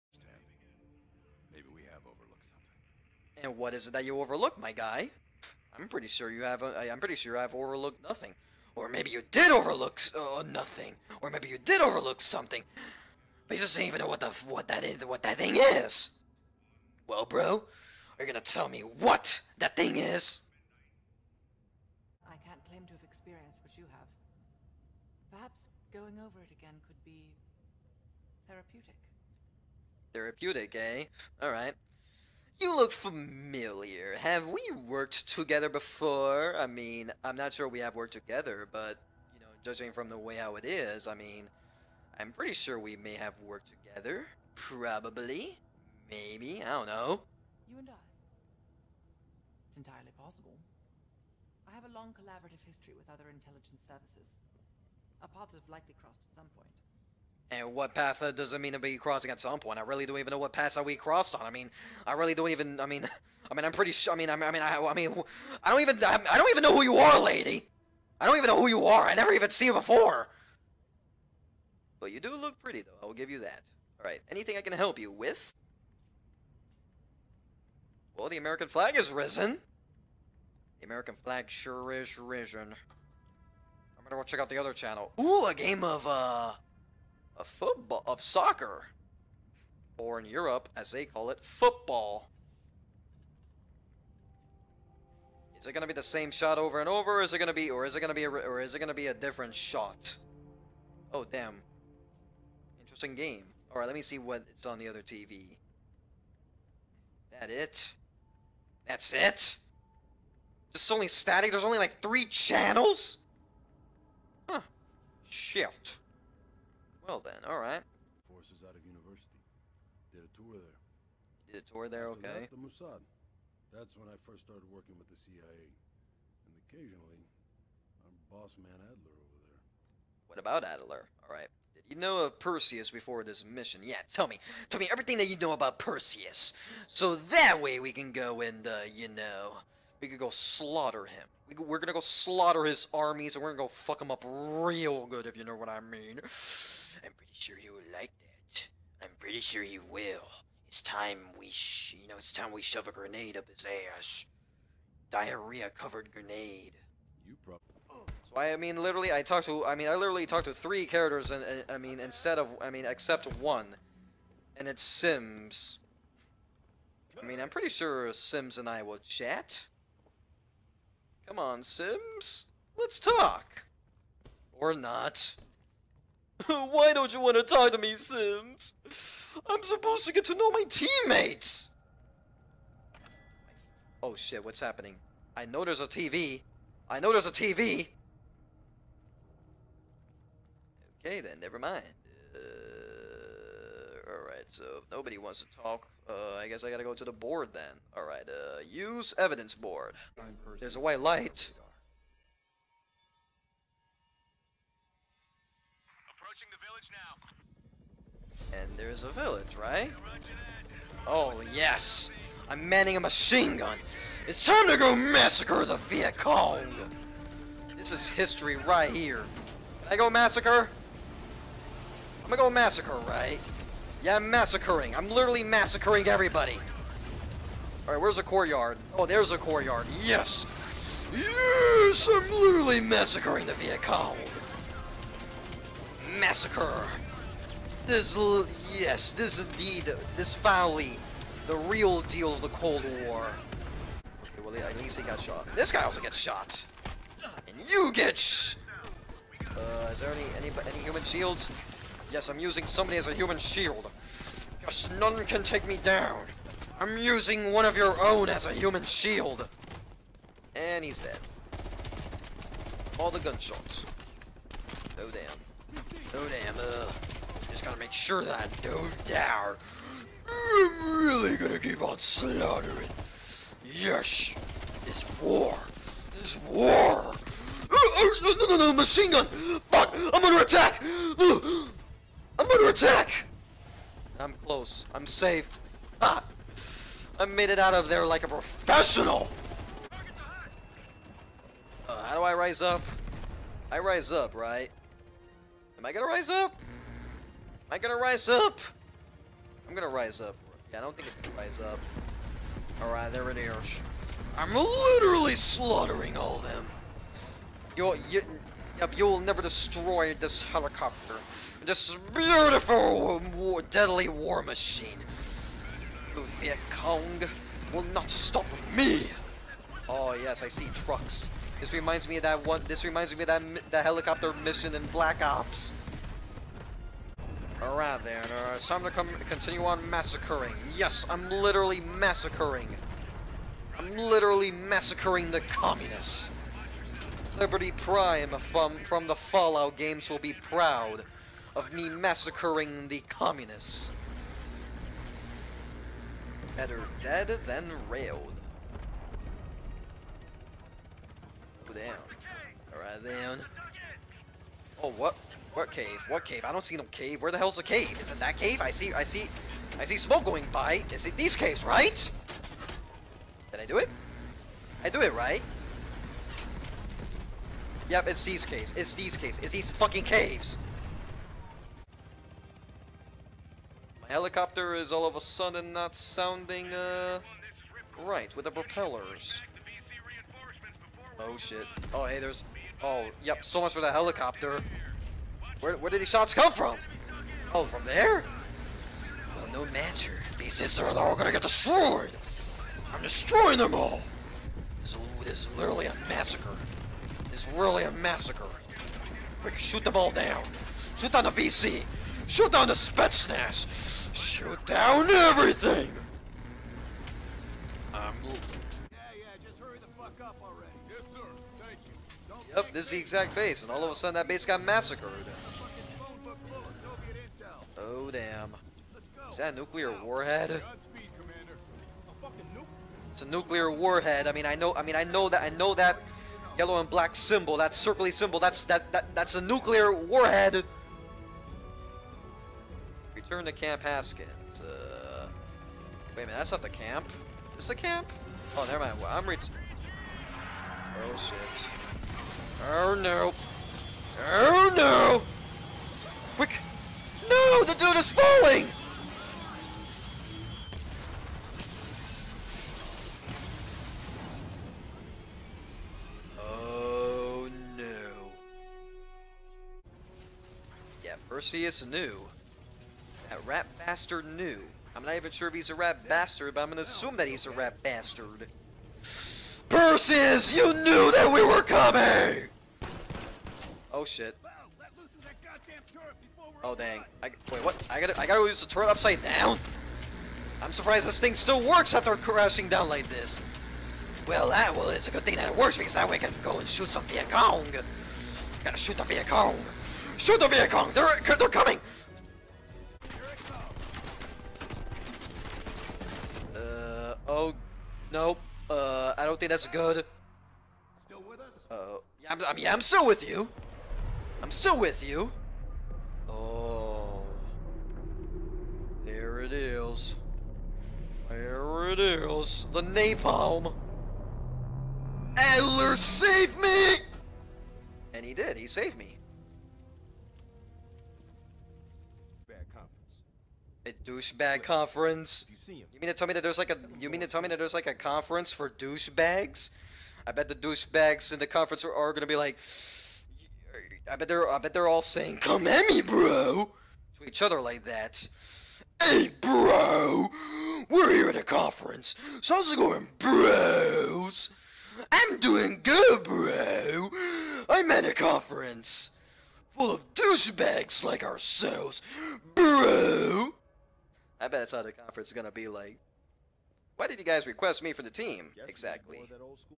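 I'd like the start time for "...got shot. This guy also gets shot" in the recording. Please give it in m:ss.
4:05.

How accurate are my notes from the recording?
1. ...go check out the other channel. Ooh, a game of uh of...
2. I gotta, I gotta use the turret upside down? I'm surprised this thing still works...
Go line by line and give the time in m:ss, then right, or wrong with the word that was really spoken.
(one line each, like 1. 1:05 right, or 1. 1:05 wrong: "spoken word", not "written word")
1. 1:24 right
2. 7:57 right.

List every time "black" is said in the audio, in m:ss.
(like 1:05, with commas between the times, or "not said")
5:24, 7:06.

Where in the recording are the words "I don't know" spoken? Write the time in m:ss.
0:46.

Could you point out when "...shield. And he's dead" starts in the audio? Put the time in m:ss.
4:18.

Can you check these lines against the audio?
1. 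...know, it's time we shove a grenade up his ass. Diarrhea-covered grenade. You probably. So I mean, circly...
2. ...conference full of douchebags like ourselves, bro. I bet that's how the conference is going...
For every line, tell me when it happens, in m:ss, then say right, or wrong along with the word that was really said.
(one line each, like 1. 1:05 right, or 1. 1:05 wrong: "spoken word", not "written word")
1. 2:32 wrong: "literally", not "circly"
2. 9:08 right.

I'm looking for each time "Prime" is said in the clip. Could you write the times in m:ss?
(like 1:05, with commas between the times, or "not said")
5:37.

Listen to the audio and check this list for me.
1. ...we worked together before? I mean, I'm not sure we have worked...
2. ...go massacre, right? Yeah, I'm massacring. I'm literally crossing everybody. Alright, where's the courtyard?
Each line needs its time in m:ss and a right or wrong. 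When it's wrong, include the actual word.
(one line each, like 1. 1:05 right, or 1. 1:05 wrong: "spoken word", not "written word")
1. 0:34 right
2. 3:42 wrong: "massacring", not "crossing".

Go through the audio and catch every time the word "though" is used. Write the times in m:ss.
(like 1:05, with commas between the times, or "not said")
1:12.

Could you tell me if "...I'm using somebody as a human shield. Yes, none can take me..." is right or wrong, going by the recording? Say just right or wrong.
right.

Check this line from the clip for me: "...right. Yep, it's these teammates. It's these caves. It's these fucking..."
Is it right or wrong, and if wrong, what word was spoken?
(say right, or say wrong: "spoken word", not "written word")
wrong: "caves", not "teammates".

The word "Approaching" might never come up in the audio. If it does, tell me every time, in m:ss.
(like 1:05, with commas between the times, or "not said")
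3:26.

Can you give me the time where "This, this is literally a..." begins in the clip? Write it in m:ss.
6:34.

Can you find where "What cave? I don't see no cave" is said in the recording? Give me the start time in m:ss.
5:56.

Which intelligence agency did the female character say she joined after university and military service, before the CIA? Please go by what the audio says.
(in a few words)
Mossad.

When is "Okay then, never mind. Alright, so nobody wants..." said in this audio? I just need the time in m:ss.
3:10.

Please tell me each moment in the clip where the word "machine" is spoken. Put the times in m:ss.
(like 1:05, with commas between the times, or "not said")
3:32, 4:38, 5:14.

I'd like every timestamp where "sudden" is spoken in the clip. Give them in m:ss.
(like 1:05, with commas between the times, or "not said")
6:15, 6:53.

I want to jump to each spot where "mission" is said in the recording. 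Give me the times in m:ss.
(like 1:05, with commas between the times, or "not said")
2:13, 5:24.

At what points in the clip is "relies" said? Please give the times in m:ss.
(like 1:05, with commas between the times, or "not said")
not said.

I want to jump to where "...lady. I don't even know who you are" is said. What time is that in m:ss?
1:07.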